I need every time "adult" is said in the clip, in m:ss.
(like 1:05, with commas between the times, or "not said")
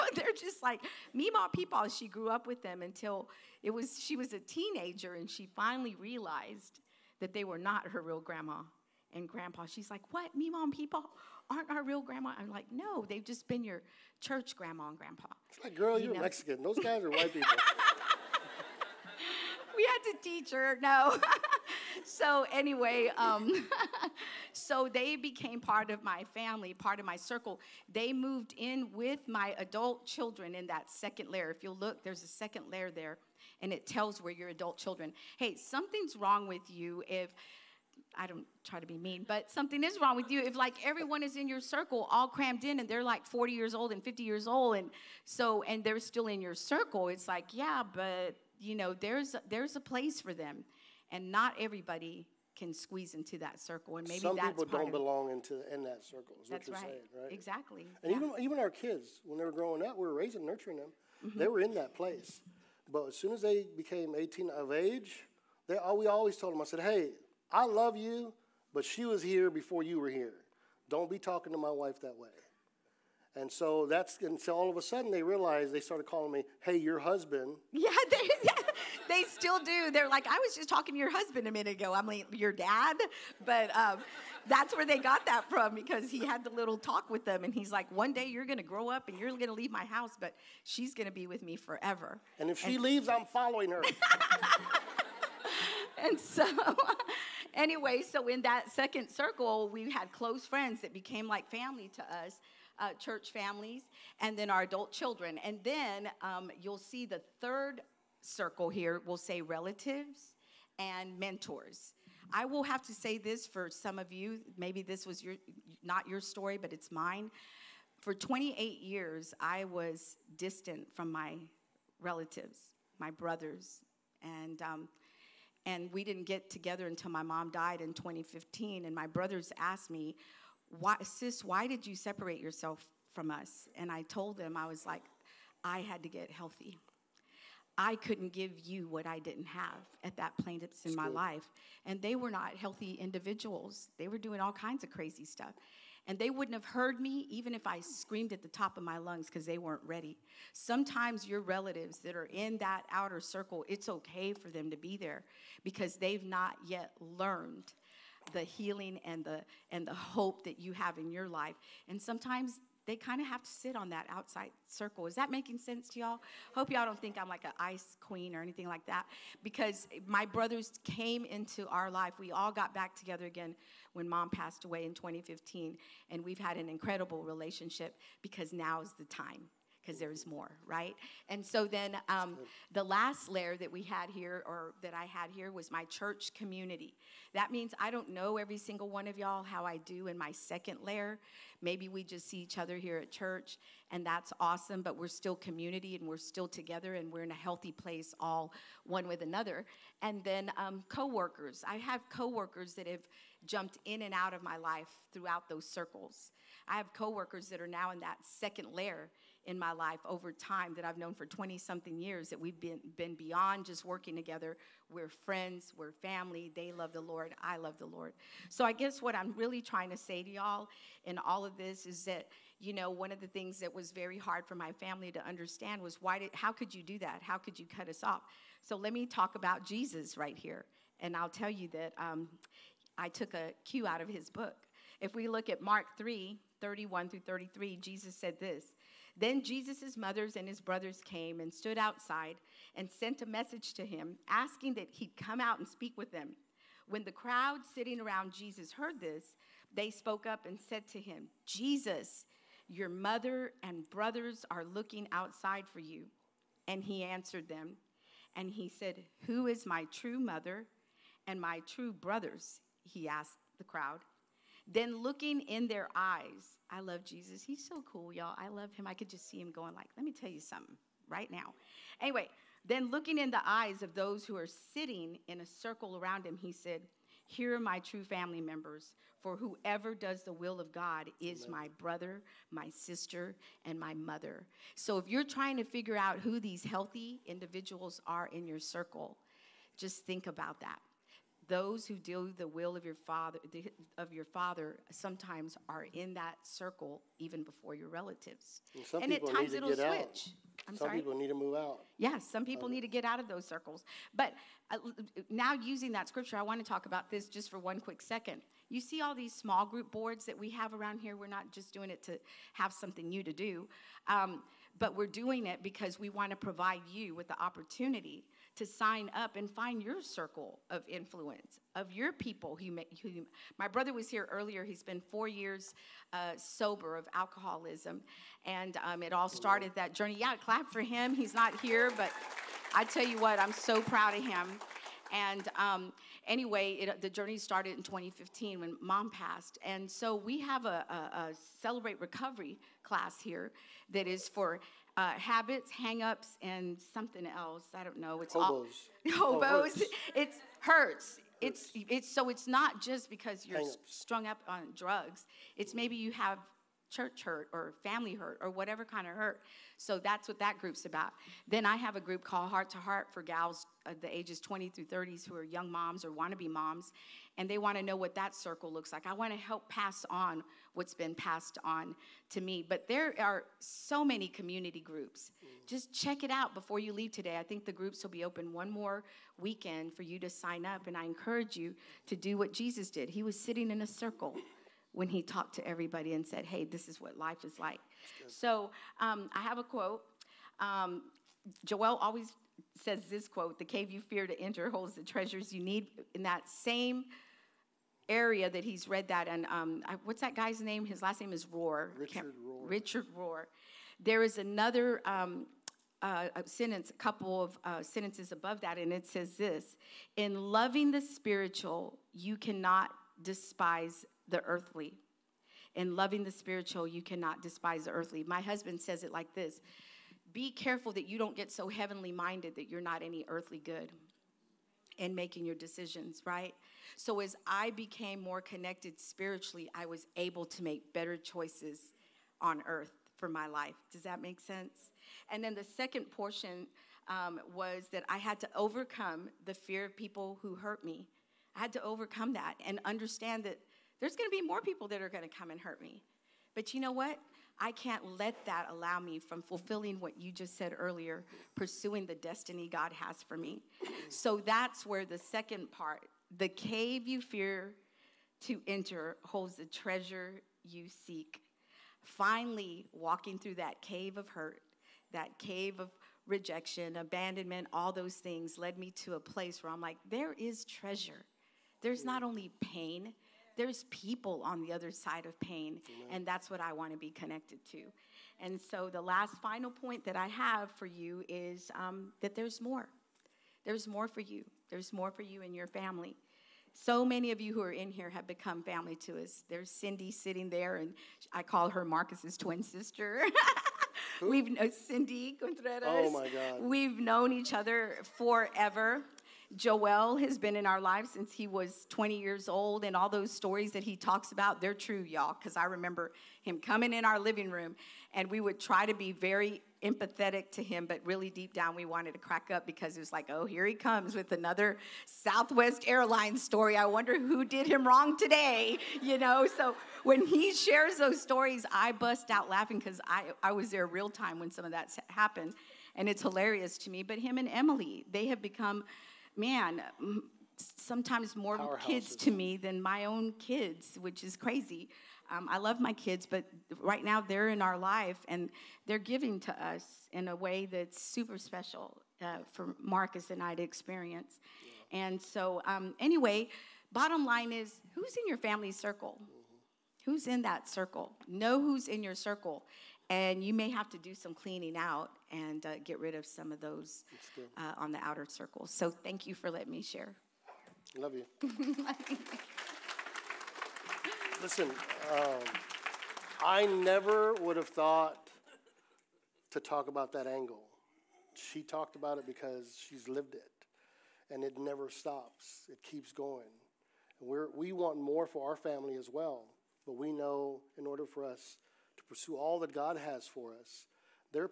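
0:29, 0:34, 1:44.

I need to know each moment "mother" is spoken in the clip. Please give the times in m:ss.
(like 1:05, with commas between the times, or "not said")
3:59, 4:12, 4:20, 4:43.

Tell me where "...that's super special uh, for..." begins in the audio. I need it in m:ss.
9:00.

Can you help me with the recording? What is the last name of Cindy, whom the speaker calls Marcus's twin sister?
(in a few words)
Contreras.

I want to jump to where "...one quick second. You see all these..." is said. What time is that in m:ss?
5:07.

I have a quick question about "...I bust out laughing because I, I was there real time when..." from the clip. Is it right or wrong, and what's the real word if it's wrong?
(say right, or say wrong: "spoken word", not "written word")
right.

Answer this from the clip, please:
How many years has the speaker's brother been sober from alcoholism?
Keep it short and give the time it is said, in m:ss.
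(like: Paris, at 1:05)
4, at 5:25.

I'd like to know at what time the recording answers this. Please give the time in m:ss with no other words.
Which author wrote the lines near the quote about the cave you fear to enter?
6:41.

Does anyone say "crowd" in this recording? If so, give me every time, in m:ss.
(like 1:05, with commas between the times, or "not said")
4:07, 4:23.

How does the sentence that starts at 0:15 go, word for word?
It's like, girl, you are Mexican.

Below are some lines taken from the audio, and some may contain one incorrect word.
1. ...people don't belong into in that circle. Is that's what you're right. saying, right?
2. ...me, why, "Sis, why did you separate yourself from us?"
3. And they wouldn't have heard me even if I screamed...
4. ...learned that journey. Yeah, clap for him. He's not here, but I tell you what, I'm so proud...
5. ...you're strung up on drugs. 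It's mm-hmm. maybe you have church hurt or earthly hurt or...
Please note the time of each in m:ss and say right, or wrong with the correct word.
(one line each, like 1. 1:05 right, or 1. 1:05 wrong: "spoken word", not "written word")
1. 0:54 right
2. 2:09 right
3. 2:26 right
4. 5:29 wrong: "started", not "learned"
5. 5:53 wrong: "family", not "earthly".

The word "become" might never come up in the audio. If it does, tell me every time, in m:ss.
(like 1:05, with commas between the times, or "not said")
8:08, 8:48.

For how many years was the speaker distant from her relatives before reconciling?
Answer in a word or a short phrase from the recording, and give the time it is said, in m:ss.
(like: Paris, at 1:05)
28, at 1:58.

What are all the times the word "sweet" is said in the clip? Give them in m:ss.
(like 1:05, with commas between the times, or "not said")
not said.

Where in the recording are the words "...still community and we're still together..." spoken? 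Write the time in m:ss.
3:15.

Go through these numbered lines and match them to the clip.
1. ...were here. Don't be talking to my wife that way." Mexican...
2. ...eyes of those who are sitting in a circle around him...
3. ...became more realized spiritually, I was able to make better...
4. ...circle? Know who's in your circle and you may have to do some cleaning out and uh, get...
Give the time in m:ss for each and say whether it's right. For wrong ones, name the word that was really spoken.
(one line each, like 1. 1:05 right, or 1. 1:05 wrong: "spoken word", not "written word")
1. 1:10 wrong: "And", not "Mexican"
2. 4:33 right
3. 7:07 wrong: "connected", not "realized"
4. 9:10 right.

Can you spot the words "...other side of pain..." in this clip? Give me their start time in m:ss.
7:54.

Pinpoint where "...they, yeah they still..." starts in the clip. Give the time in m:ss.
1:18.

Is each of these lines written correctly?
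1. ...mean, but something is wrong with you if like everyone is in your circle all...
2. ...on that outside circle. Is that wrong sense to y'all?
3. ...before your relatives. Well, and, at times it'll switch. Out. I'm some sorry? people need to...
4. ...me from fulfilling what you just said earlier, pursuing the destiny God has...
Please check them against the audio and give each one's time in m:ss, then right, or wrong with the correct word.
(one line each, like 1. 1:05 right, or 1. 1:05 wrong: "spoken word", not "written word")
1. 0:38 right
2. 2:43 wrong: "making", not "wrong"
3. 4:57 right
4. 7:28 right.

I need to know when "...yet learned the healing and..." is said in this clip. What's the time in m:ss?
2:36.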